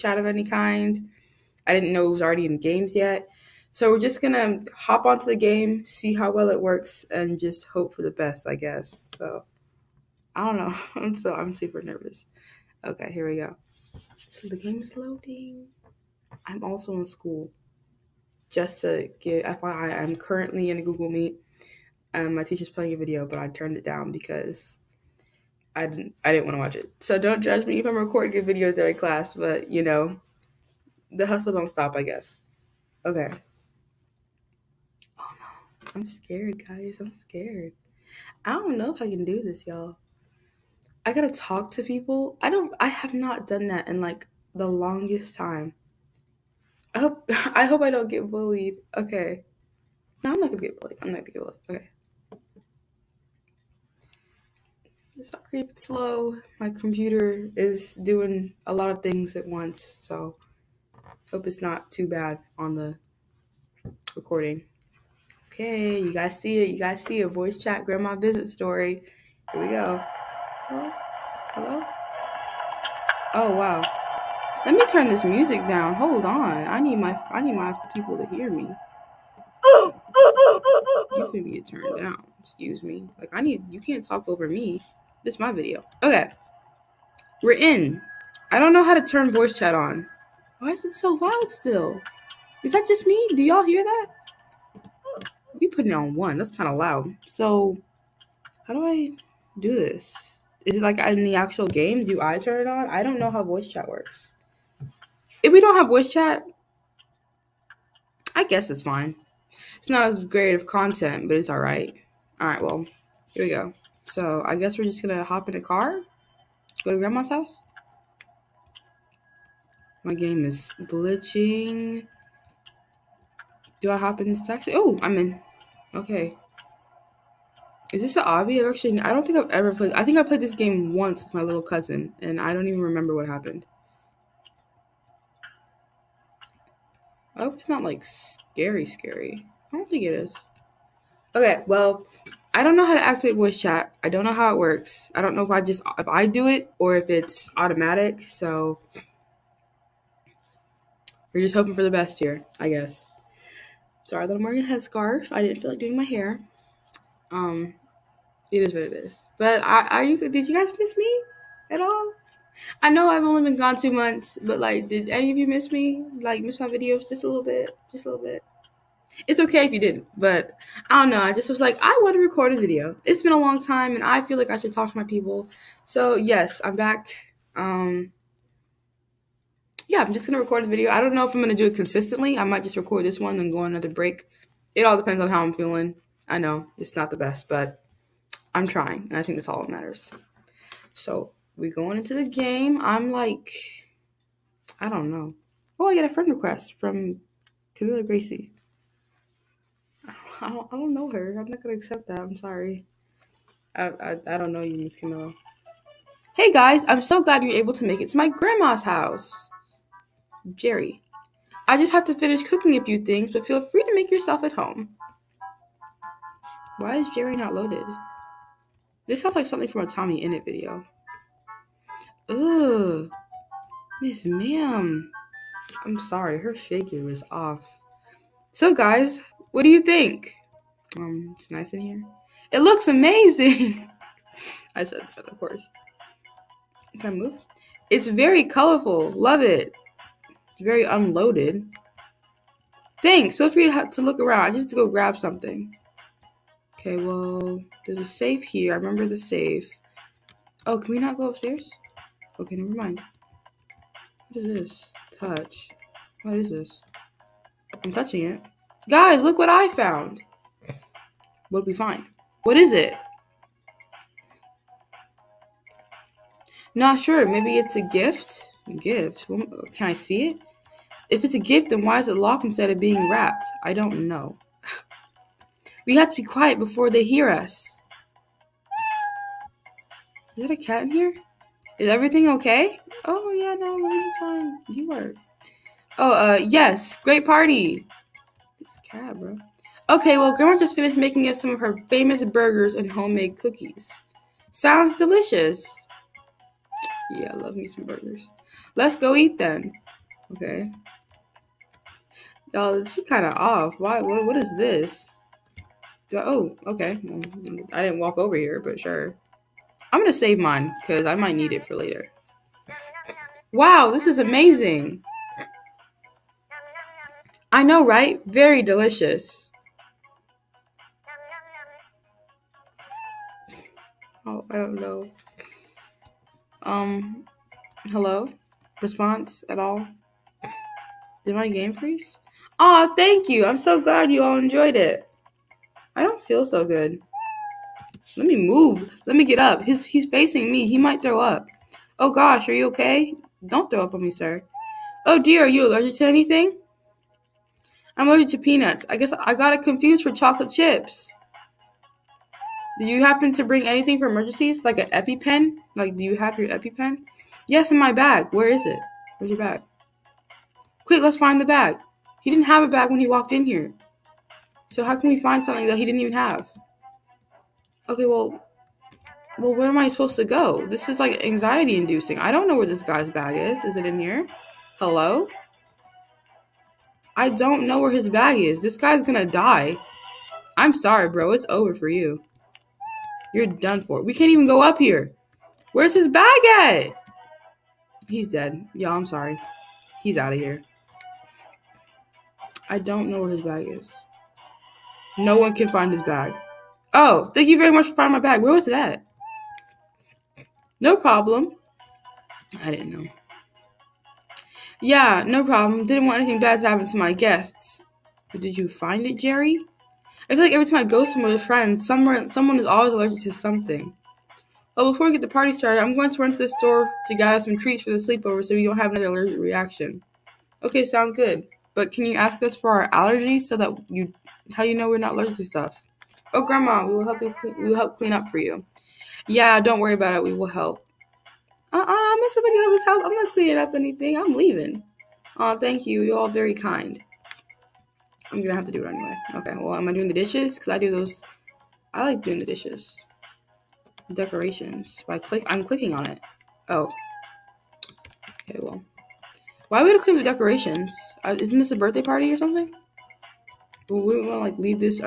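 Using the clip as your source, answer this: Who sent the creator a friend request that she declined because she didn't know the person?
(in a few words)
Camilla Gracie.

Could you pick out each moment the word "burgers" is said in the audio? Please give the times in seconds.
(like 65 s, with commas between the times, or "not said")
292 s, 297 s.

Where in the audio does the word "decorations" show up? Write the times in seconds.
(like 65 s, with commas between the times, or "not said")
444 s, 450 s.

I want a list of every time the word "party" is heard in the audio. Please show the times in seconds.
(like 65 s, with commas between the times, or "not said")
287 s, 415 s, 452 s.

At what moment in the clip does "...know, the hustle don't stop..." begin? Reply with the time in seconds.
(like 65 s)
29 s.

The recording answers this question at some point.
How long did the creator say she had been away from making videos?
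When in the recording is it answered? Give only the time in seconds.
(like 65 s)
163 s.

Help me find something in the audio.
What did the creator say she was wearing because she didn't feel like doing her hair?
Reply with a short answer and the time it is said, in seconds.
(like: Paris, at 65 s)
headscarf, at 154 s.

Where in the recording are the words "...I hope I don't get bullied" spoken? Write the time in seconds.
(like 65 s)
47 s.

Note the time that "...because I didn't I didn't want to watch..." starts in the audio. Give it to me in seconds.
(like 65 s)
24 s.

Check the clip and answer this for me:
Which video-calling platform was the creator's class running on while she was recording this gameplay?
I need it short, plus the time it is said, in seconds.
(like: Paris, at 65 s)
Google Meet, at 20 s.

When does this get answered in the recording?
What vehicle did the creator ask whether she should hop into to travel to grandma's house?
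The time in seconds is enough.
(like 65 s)
124 s.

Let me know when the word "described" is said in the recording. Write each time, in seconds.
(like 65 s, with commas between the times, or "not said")
not said.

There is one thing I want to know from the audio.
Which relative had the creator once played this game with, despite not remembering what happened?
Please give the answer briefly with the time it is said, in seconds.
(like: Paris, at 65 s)
little cousin, at 131 s.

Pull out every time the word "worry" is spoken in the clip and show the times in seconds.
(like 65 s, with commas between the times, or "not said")
429 s.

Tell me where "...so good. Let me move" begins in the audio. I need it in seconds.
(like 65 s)
336 s.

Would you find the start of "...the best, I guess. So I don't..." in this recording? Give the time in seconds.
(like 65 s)
8 s.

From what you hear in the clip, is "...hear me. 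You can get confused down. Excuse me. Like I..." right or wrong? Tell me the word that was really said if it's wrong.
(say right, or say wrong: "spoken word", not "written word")
wrong: "turned", not "confused".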